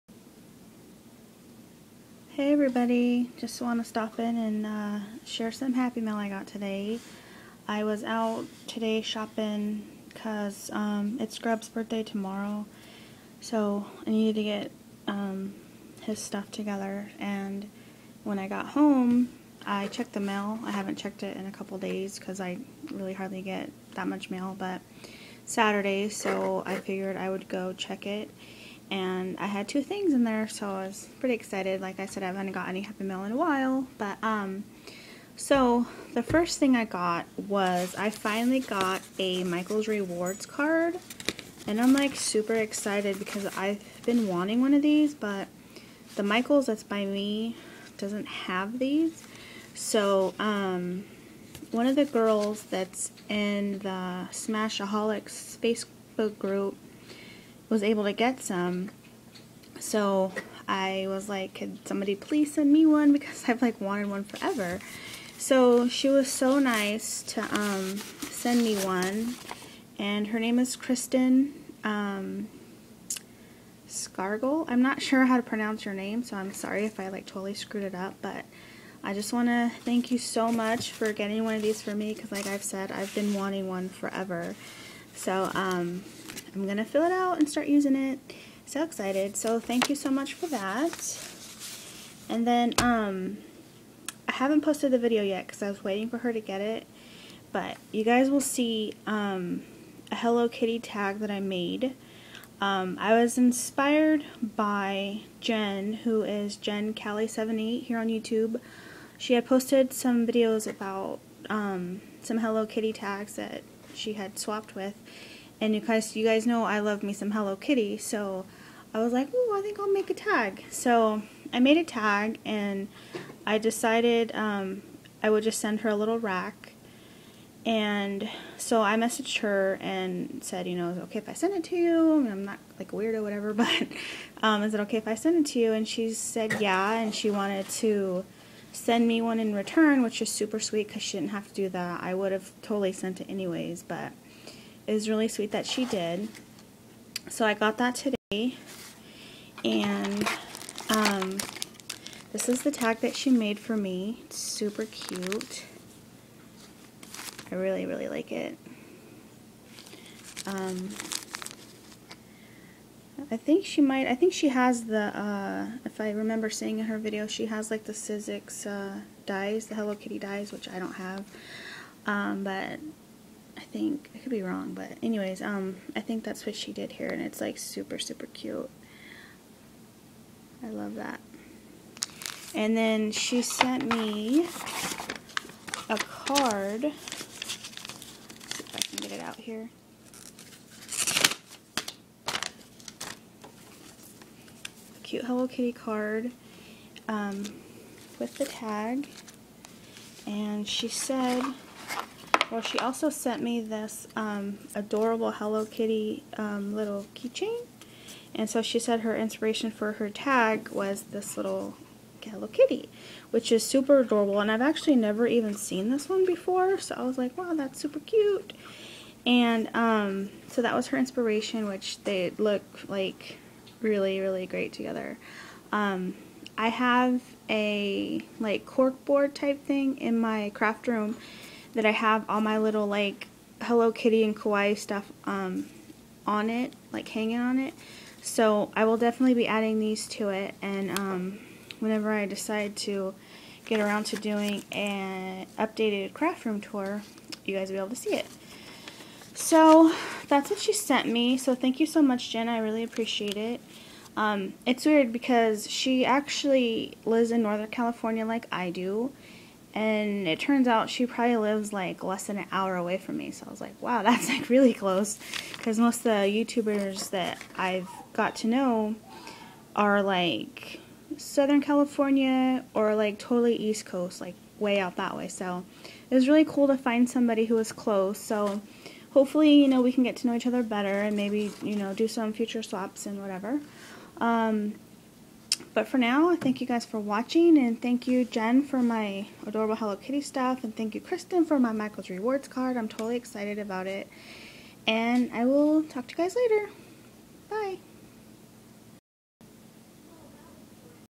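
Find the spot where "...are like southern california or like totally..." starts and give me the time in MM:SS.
04:29.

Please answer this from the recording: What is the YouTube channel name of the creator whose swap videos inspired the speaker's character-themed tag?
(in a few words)
Jencali78.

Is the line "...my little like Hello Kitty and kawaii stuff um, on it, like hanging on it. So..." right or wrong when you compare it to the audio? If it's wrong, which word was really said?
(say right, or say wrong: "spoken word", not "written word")
right.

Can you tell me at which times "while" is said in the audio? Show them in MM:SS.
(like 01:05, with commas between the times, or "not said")
00:33.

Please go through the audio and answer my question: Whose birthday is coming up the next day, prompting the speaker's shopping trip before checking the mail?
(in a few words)
Grub.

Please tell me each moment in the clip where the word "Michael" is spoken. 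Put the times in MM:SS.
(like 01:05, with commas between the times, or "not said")
00:39, 00:46, 04:51.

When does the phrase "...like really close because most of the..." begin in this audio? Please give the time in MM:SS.
04:24.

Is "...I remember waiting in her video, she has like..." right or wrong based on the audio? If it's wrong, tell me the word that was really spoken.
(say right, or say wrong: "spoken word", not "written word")
wrong: "seeing", not "waiting".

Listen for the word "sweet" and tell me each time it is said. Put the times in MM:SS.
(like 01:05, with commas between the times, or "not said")
02:20, 02:25.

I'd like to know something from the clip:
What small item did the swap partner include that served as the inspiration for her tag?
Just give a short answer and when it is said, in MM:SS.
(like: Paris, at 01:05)
keychain, at 03:27.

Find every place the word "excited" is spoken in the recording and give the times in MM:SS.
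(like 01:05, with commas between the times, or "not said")
00:31, 00:42, 01:28, 04:53.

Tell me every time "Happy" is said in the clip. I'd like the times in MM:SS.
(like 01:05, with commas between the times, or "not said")
00:05, 00:32.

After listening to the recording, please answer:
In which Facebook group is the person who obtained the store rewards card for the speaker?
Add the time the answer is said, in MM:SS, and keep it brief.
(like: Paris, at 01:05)
Smashaholics, at 00:54.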